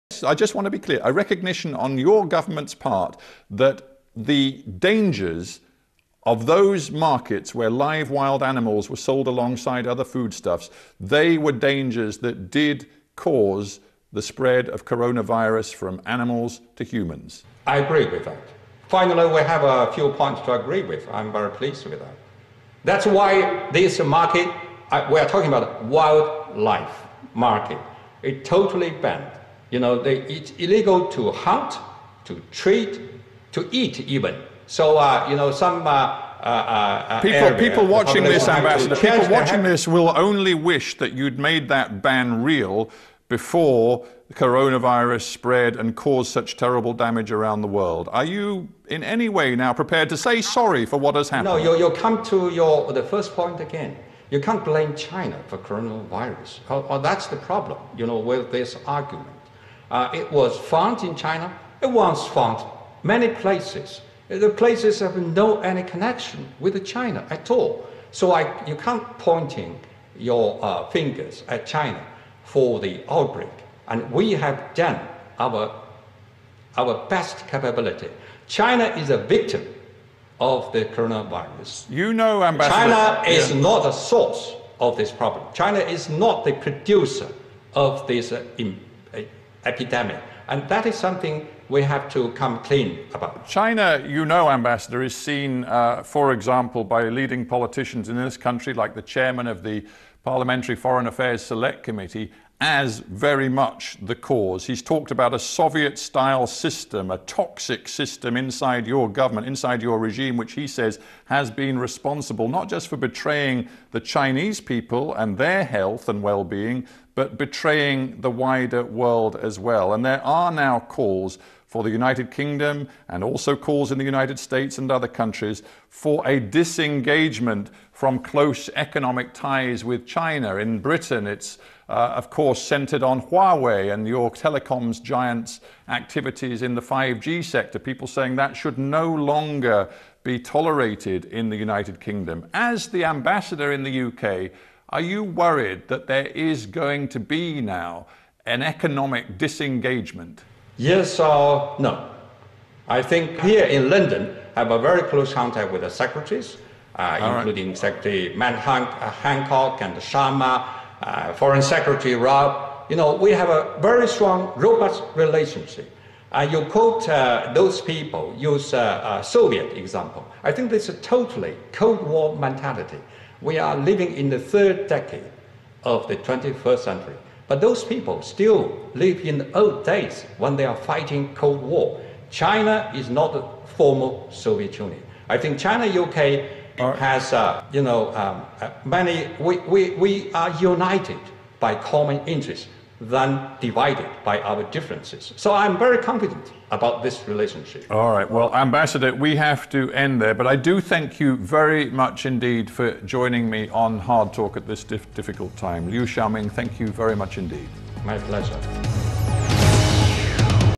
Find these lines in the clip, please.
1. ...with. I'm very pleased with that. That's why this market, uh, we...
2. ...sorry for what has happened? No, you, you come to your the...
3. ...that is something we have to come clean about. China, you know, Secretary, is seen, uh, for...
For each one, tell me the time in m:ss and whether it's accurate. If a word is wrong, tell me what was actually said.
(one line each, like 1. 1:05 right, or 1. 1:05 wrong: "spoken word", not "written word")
1. 0:20 right
2. 0:50 right
3. 1:30 wrong: "Ambassador", not "Secretary".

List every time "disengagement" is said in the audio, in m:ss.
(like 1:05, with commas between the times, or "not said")
2:06, 2:29.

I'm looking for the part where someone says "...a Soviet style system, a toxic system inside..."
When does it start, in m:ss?
1:45.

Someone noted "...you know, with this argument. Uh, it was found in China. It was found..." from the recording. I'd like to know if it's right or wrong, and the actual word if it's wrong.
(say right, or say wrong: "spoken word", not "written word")
right.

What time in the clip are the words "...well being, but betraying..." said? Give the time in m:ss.
1:56.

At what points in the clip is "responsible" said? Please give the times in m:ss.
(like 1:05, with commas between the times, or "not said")
1:51.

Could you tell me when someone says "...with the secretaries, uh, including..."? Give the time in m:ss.
2:35.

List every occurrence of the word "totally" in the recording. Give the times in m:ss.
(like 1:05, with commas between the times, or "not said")
0:28, 2:51.